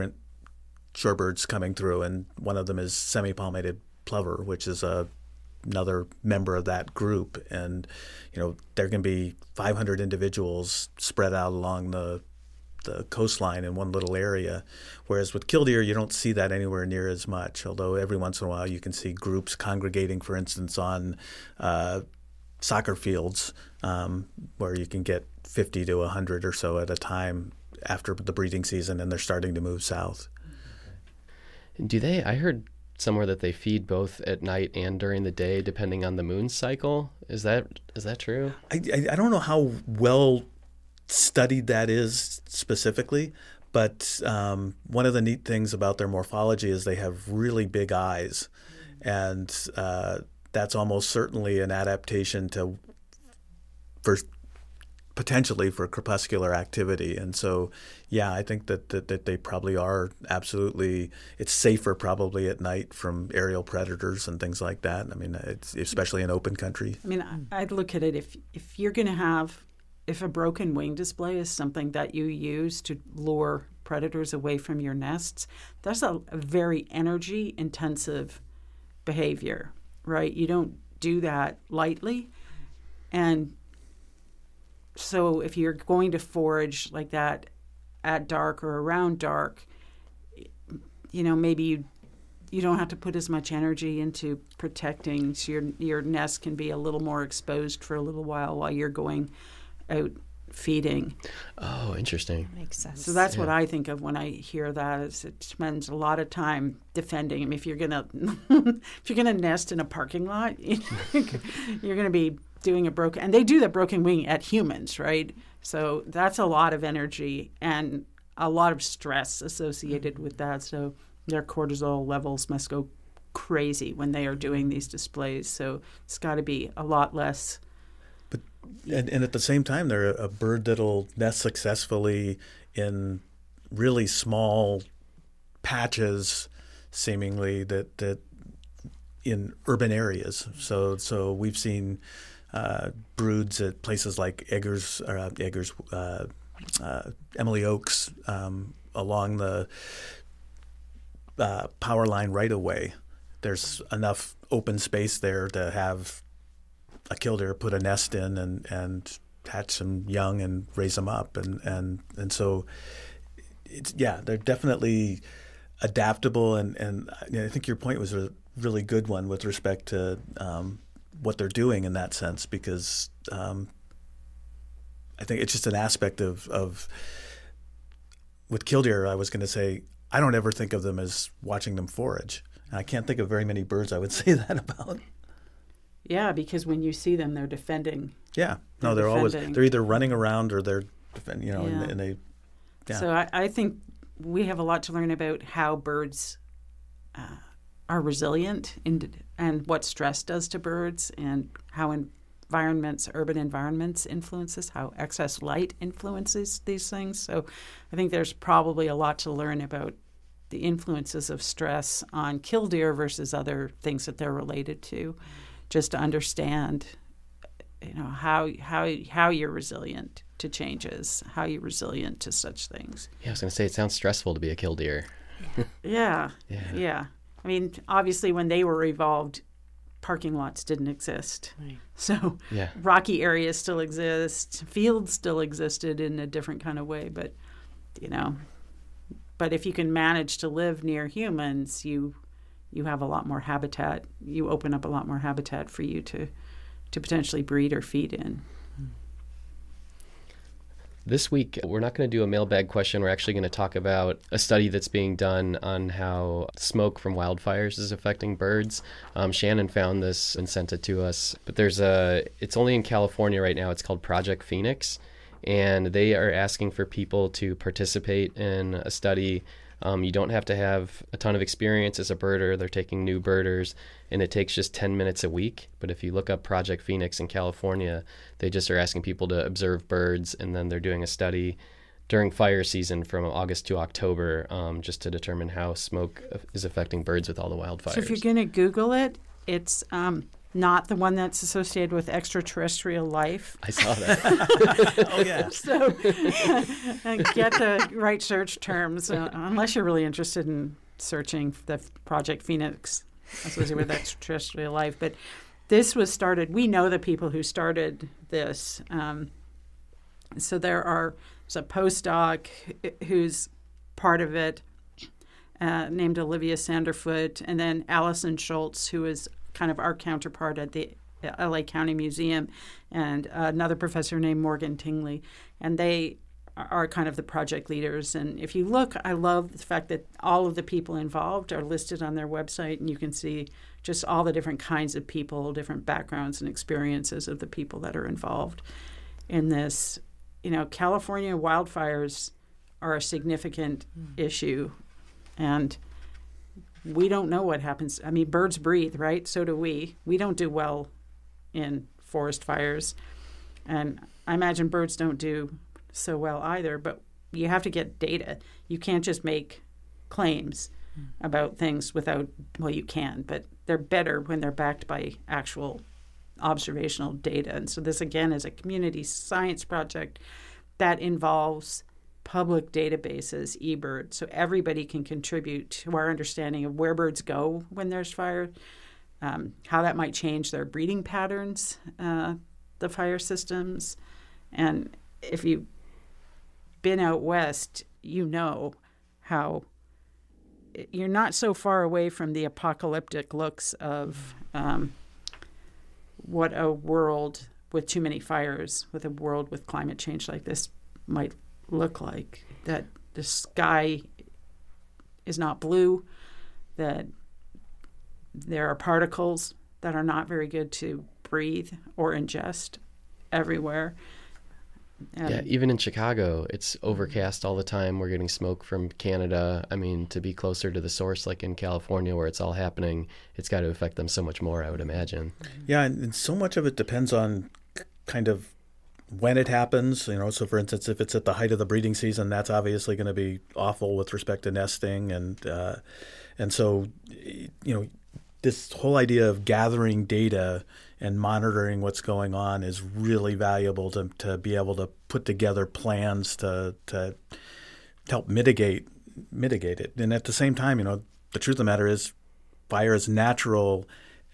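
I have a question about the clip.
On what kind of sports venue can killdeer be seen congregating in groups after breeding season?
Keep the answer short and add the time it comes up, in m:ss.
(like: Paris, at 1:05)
Soccer fields, at 0:22.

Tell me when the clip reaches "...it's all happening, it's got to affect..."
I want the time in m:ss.
7:02.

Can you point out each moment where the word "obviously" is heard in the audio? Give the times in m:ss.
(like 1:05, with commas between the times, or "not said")
3:47, 7:12.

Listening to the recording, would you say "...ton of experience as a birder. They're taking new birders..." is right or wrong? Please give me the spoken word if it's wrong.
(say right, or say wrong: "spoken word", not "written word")
right.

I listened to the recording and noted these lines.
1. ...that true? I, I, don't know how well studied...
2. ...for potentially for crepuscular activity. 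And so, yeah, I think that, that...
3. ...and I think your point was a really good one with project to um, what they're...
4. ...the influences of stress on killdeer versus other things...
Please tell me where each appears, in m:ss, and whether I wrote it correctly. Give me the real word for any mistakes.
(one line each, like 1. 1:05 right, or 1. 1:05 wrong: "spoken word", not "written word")
1. 0:38 right
2. 0:54 right
3. 2:46 wrong: "respect", not "project"
4. 3:30 right.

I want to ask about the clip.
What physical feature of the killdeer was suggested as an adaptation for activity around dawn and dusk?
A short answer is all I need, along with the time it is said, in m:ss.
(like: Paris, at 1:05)
Really big eyes, at 0:47.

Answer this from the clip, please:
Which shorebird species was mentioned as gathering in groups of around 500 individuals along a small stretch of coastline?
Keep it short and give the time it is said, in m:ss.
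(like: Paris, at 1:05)
Semi-palmated Plover, at 0:02.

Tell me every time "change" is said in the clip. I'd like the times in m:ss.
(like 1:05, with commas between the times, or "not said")
3:40, 6:20, 6:39.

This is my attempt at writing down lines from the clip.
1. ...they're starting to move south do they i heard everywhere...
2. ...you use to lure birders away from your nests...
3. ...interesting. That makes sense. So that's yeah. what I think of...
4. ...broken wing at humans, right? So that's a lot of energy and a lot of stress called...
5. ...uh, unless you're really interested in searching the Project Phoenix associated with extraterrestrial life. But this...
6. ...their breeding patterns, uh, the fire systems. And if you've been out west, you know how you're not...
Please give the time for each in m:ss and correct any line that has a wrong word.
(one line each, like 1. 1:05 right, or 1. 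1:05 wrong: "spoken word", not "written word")
1. 0:29 wrong: "somewhere", not "everywhere"
2. 1:12 wrong: "predators", not "birders"
3. 1:41 right
4. 1:53 wrong: "associated", not "called"
5. 4:59 right
6. 6:20 right.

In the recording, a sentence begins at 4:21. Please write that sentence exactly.
But there's a, it's only in California right now.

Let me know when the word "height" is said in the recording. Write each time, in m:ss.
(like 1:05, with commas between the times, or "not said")
7:11.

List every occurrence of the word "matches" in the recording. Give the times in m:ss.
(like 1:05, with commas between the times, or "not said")
not said.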